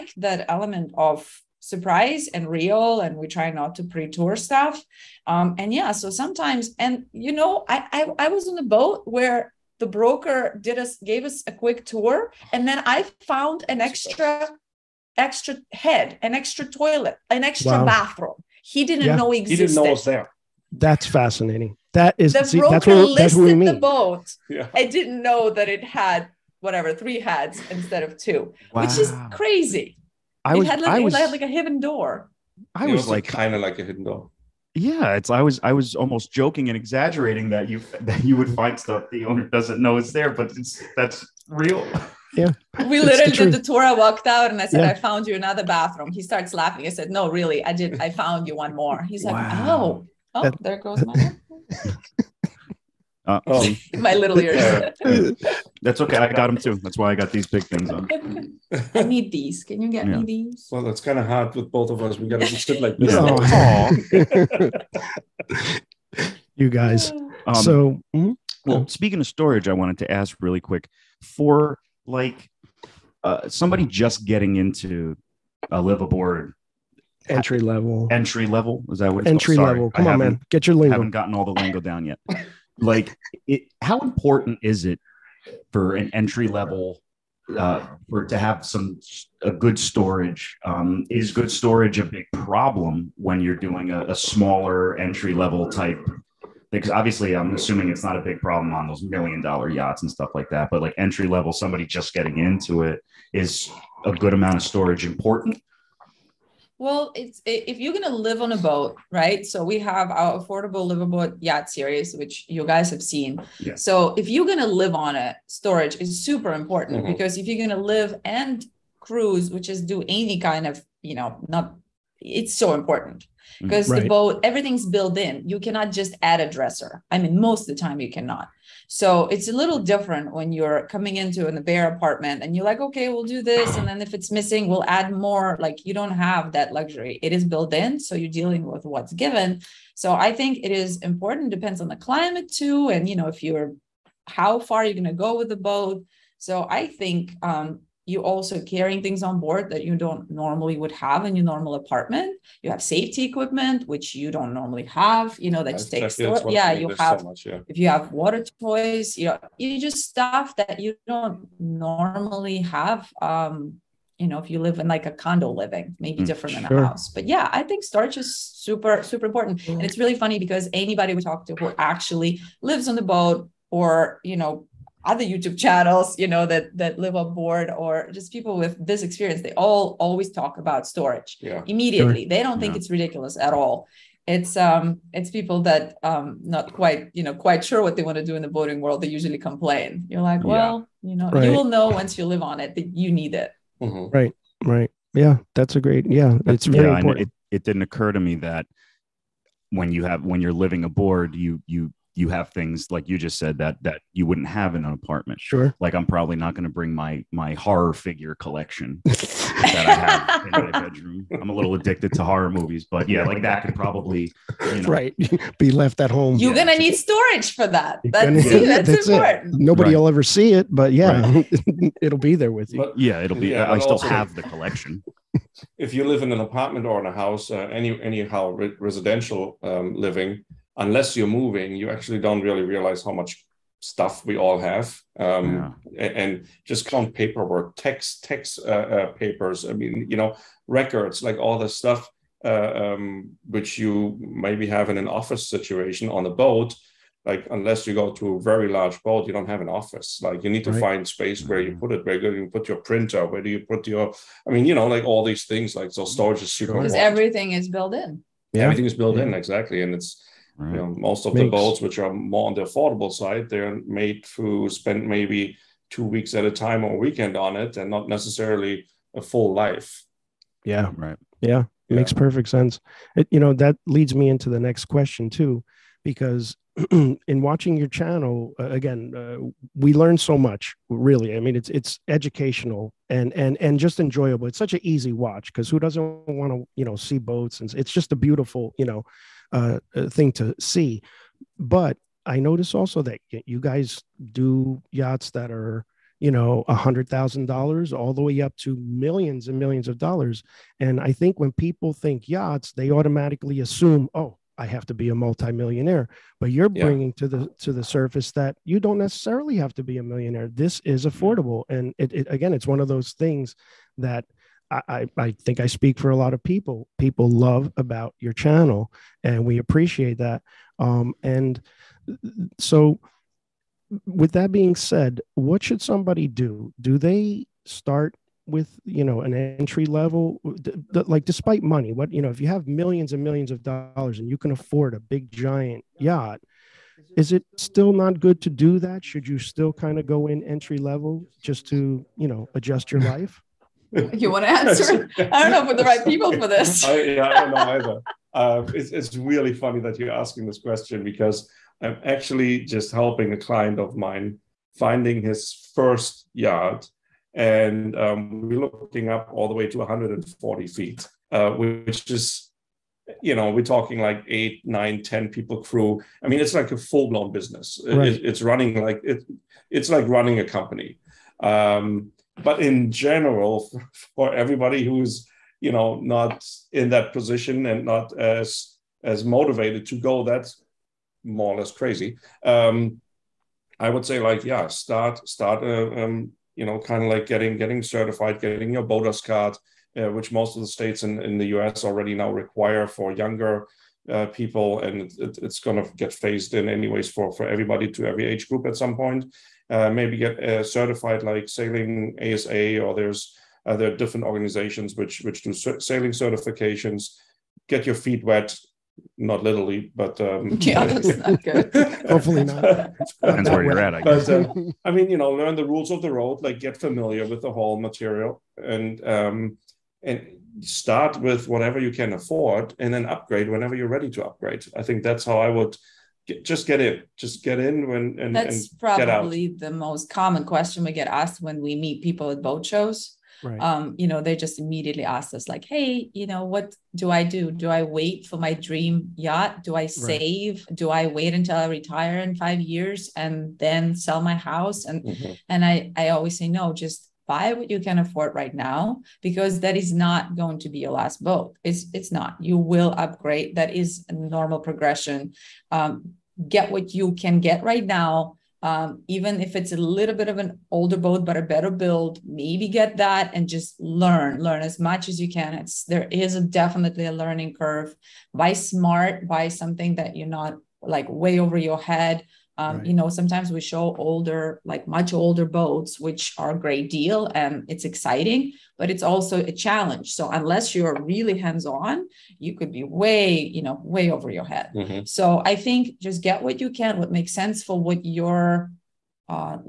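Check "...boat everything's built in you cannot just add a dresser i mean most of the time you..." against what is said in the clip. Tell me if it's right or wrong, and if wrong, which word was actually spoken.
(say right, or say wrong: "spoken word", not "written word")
right.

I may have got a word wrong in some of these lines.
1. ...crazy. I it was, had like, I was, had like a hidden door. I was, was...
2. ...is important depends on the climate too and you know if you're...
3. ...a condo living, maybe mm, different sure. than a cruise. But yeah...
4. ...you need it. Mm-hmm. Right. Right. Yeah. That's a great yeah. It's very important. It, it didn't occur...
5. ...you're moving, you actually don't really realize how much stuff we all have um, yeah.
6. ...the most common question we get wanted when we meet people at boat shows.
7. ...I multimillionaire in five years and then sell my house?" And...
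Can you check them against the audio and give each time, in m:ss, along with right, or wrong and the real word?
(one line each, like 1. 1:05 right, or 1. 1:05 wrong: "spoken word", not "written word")
1. 0:29 right
2. 2:20 right
3. 2:45 wrong: "house", not "cruise"
4. 3:12 right
5. 3:51 right
6. 7:09 wrong: "asked", not "wanted"
7. 7:21 wrong: "retire", not "multimillionaire".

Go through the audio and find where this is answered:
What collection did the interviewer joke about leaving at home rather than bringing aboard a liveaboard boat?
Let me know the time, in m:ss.
3:27.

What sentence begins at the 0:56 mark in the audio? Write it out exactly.
That's why I got these big things on.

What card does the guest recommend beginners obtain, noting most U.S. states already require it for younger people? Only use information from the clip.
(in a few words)
BODAS card.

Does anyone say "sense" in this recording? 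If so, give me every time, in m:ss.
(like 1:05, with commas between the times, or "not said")
4:32, 8:07.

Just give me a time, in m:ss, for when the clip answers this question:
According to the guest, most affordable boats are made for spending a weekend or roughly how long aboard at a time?
4:25.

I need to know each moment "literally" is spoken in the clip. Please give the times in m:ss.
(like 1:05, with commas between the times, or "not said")
0:42, 6:49.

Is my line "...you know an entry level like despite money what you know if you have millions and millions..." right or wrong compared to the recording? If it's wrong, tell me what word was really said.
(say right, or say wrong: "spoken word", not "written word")
right.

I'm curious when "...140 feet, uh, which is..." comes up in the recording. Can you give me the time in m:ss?
5:59.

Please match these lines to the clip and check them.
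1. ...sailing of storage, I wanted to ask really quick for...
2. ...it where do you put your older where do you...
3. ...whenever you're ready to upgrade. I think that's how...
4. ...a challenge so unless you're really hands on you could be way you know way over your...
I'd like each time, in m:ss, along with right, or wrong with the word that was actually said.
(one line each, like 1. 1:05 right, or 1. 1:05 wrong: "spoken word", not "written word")
1. 1:08 wrong: "speaking", not "sailing"
2. 4:11 wrong: "printer", not "older"
3. 7:03 right
4. 7:59 right.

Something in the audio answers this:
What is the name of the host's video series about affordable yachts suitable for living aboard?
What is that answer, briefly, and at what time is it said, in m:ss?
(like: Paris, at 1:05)
affordable livable yacht series, at 1:50.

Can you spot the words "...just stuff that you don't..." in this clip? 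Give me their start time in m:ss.
2:39.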